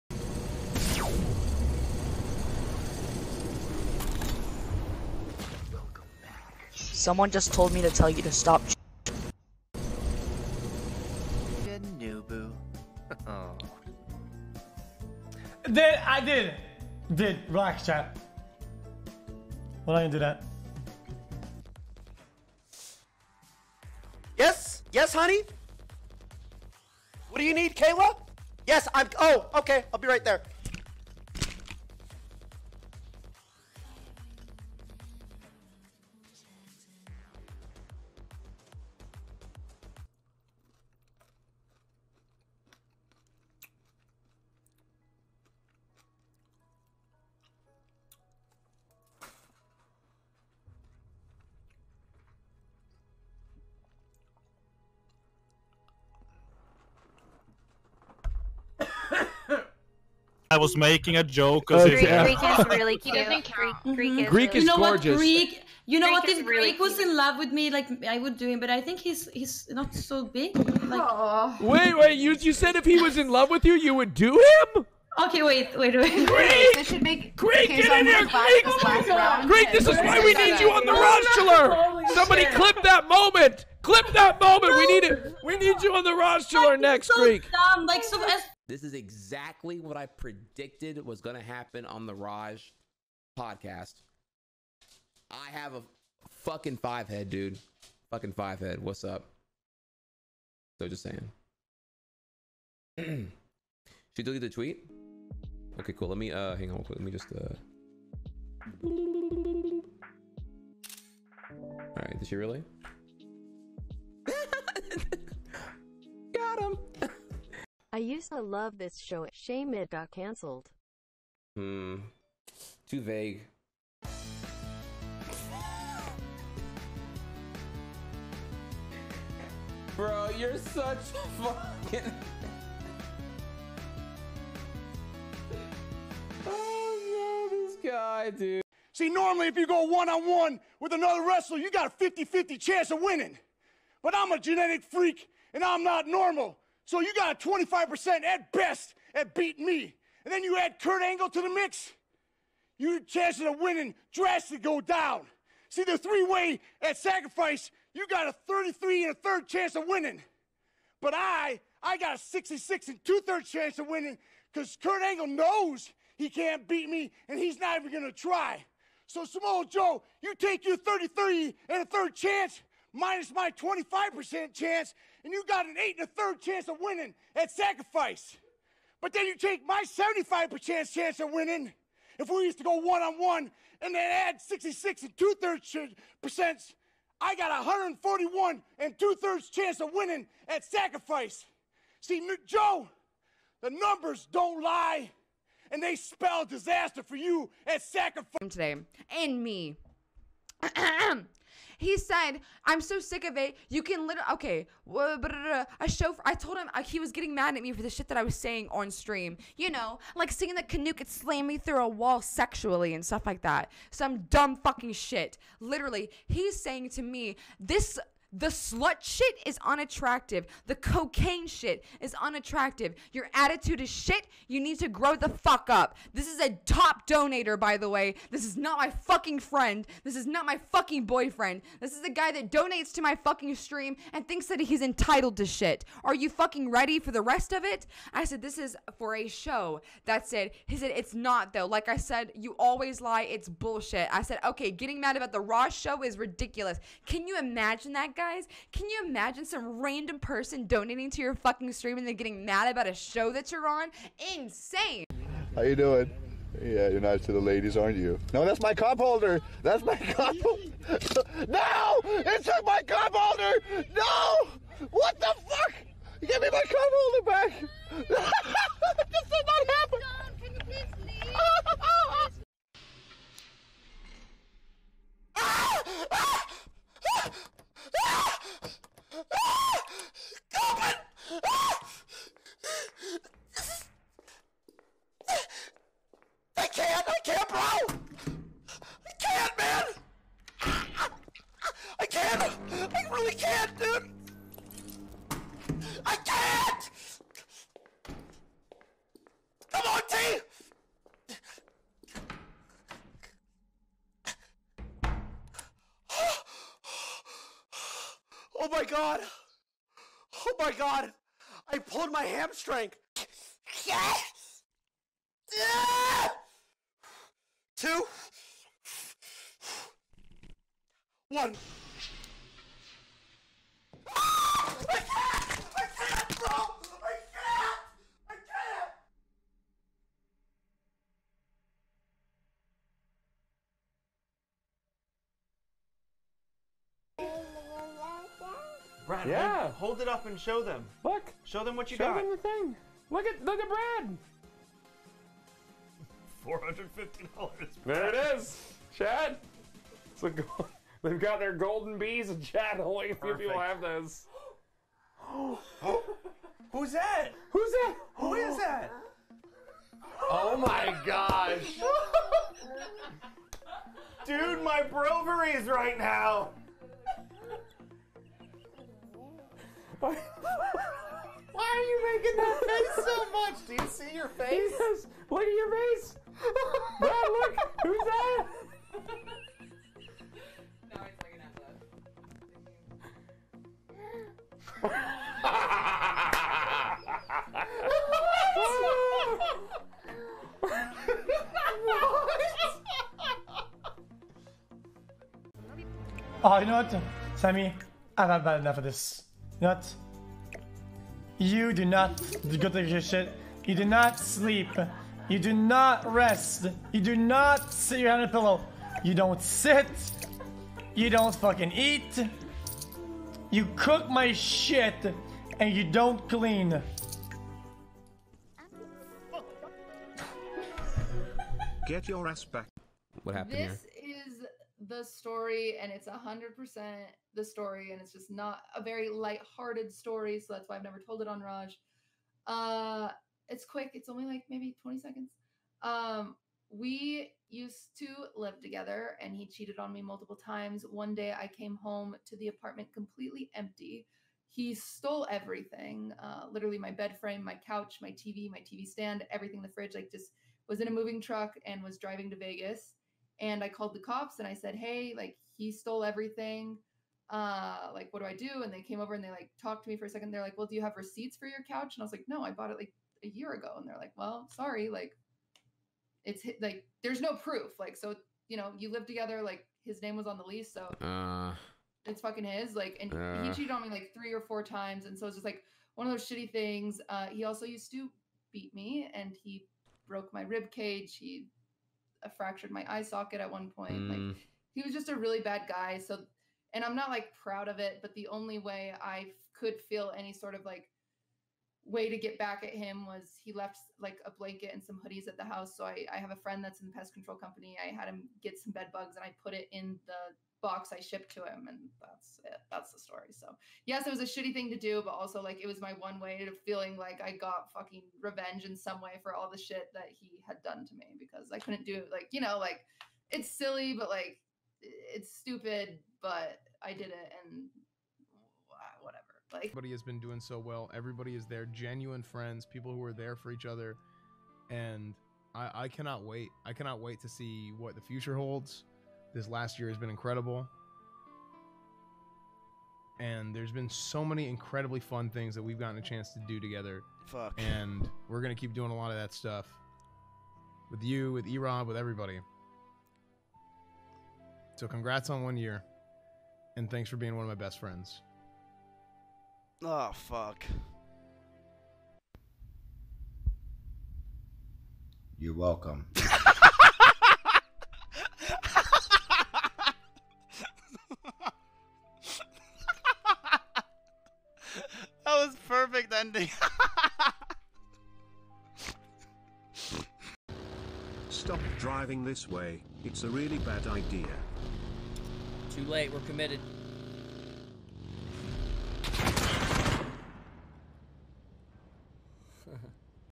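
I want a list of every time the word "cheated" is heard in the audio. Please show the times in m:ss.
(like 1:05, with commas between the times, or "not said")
7:19, 7:53.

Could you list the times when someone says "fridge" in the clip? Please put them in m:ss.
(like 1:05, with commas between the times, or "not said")
7:29.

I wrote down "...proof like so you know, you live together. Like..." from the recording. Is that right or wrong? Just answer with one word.
right.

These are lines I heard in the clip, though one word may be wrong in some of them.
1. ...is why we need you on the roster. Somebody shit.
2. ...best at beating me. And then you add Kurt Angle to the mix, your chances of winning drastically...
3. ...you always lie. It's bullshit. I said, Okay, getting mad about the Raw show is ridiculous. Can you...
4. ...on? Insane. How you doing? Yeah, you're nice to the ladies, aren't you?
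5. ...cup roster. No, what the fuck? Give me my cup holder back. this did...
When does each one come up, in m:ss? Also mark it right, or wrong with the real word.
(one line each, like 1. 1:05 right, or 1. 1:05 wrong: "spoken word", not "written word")
1. 1:19 right
2. 2:28 right
3. 4:02 right
4. 4:13 right
5. 4:22 wrong: "holder", not "roster".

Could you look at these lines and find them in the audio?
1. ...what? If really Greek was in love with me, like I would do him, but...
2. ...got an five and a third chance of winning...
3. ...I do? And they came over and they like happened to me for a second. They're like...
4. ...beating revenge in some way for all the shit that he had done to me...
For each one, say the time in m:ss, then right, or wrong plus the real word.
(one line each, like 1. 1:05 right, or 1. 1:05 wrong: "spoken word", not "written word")
1. 1:06 right
2. 2:55 wrong: "eight", not "five"
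3. 7:38 wrong: "talked", not "happened"
4. 8:27 wrong: "fucking", not "beating".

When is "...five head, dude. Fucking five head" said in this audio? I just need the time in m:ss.
1:36.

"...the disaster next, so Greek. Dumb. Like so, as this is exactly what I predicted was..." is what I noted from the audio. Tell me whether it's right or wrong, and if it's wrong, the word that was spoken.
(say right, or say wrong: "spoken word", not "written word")
wrong: "roster", not "disaster".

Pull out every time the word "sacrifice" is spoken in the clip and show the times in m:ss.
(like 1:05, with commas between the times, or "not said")
2:36, 2:57, 3:10, 3:17.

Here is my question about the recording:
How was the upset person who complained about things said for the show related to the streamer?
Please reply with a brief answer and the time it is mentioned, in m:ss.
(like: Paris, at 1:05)
A top donator, at 3:46.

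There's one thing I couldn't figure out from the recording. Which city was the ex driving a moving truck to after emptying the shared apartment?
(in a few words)
Vegas.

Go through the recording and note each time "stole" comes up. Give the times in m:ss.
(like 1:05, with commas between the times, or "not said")
7:24, 7:35.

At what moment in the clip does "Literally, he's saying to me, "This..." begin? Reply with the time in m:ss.
3:35.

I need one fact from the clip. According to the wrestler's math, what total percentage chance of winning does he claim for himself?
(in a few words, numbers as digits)
141 and two thirds.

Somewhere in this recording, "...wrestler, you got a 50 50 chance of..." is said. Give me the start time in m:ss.
2:21.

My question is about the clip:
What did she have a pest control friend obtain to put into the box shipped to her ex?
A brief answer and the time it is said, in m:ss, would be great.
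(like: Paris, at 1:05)
Bed bugs, at 8:18.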